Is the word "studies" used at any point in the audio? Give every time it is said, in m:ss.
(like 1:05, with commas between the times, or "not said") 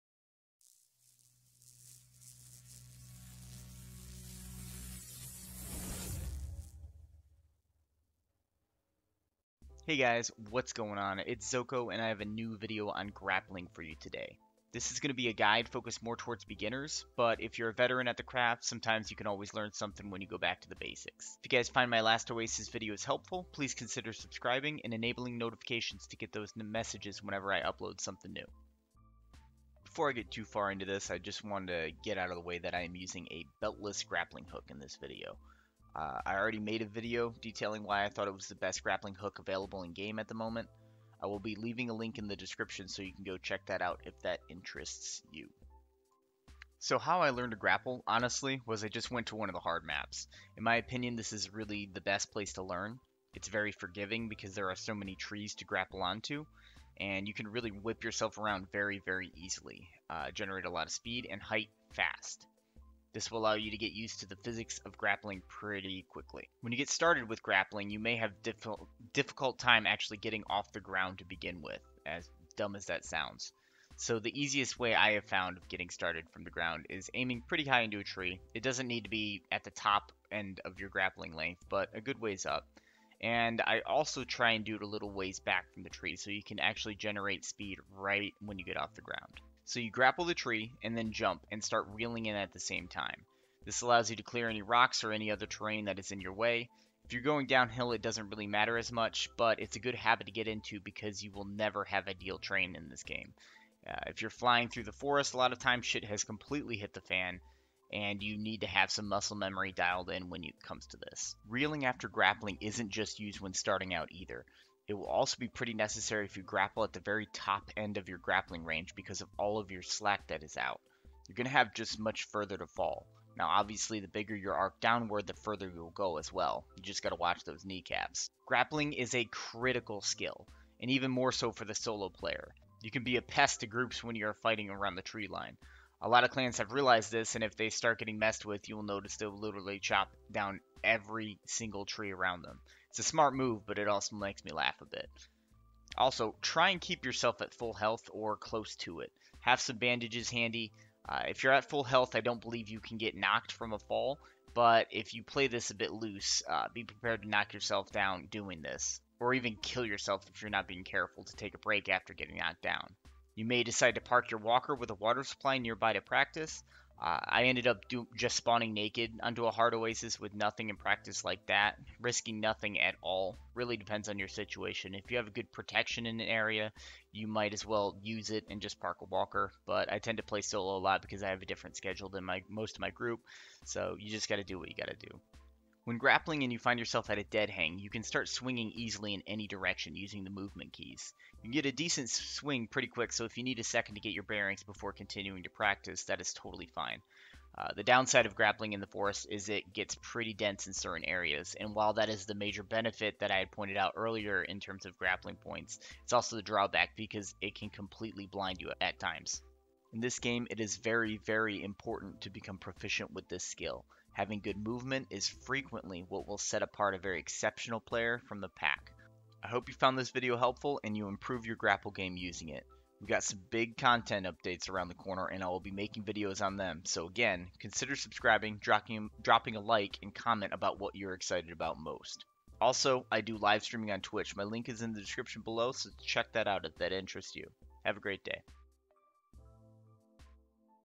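not said.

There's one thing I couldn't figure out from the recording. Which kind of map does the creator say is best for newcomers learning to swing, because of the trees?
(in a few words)
Hard maps.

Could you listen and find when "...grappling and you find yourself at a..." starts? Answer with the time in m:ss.
3:05.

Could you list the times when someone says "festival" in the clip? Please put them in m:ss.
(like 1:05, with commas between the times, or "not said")
not said.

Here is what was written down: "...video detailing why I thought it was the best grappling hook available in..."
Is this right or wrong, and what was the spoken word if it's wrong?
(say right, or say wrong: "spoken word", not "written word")
right.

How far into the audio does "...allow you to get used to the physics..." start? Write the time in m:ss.
1:03.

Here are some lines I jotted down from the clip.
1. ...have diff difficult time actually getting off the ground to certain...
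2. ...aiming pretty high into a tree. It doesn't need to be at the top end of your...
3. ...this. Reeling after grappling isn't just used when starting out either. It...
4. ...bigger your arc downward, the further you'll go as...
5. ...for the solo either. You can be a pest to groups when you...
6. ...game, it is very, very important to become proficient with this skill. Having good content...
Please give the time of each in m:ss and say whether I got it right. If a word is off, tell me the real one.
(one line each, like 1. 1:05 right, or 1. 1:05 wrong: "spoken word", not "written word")
1. 1:08 wrong: "begin", not "certain"
2. 1:17 right
3. 1:50 right
4. 2:04 right
5. 2:11 wrong: "player", not "either"
6. 3:30 wrong: "movement", not "content".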